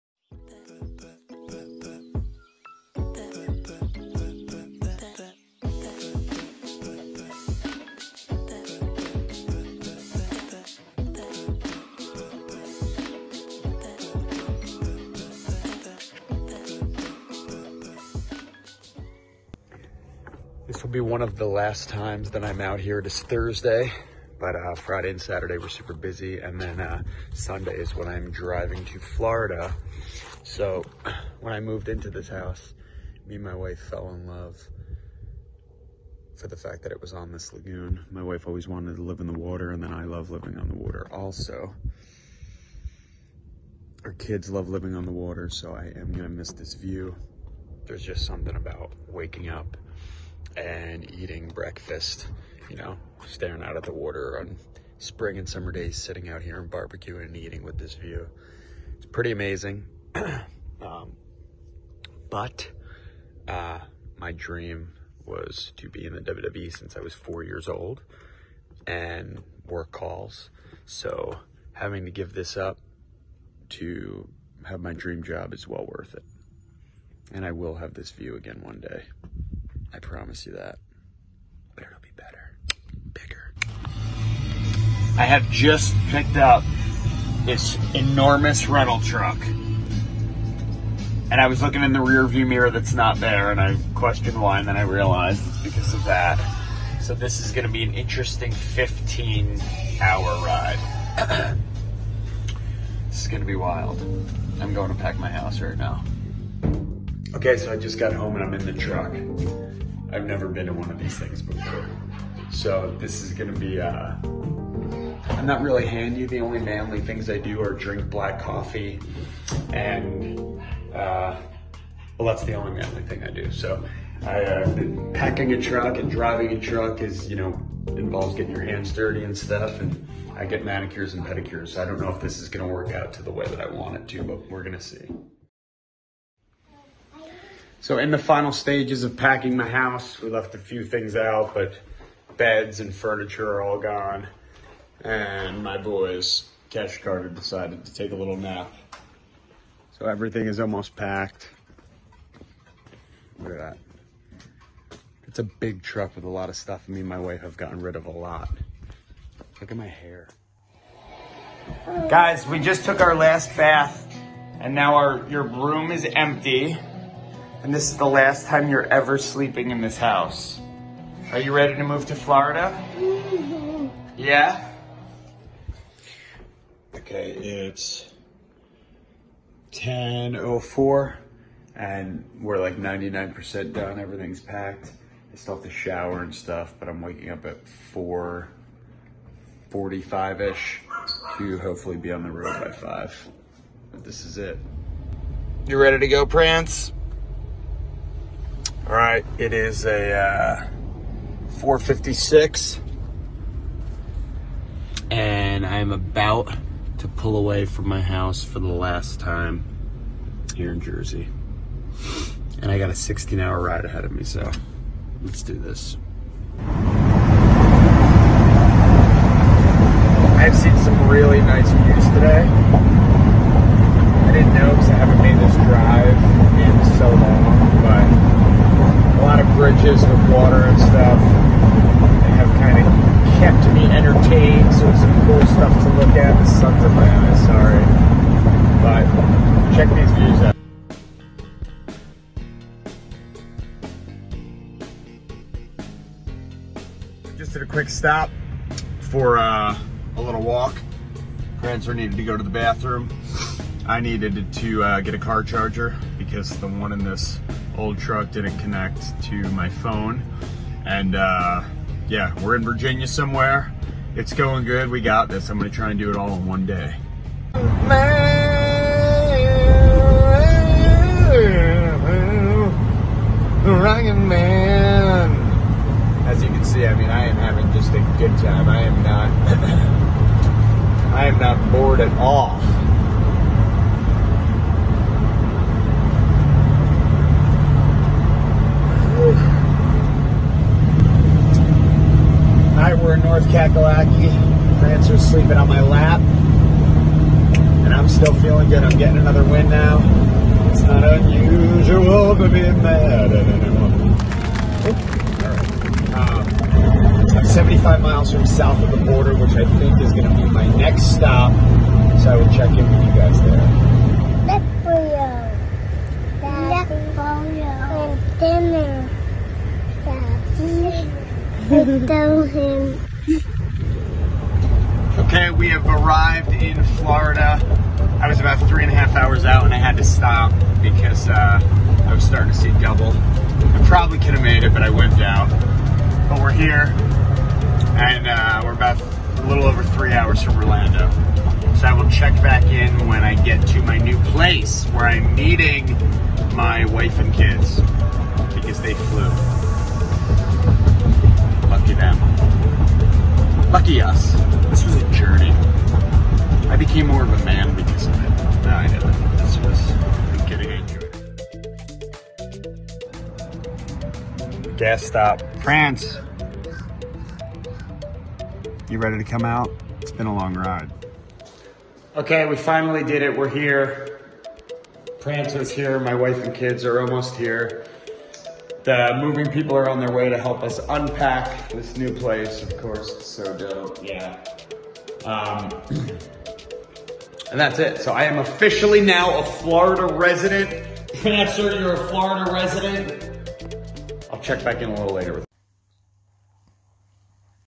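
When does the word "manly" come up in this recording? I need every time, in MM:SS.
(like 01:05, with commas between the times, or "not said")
01:56, 02:02.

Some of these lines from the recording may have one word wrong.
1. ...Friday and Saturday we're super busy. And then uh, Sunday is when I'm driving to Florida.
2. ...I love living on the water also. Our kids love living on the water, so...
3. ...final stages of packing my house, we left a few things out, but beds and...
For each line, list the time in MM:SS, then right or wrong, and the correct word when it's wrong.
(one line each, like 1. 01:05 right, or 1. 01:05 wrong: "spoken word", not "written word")
1. 00:24 right
2. 00:39 right
3. 02:18 right.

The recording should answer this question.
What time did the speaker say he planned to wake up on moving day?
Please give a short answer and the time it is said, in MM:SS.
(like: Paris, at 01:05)
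4:45, at 03:07.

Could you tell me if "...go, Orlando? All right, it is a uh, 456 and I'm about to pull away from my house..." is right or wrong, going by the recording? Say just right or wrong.
wrong.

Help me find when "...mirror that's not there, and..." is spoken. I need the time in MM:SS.
01:32.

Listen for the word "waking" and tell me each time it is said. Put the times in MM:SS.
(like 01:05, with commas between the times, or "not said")
00:49, 03:07.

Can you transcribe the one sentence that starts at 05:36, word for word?
But we're here and uh, we're about a little over three hours from Orlando.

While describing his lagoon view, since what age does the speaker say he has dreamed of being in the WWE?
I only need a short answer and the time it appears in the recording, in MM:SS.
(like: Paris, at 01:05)
4, at 01:07.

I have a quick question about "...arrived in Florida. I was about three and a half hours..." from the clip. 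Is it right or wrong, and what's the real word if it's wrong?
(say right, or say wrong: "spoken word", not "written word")
right.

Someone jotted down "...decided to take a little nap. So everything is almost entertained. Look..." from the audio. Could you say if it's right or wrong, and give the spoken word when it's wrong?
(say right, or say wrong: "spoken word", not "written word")
wrong: "packed", not "entertained".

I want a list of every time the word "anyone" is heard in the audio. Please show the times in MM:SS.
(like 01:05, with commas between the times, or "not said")
05:03.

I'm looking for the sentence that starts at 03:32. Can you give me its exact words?
And I got a 16 hour ride ahead of me, so let's do this.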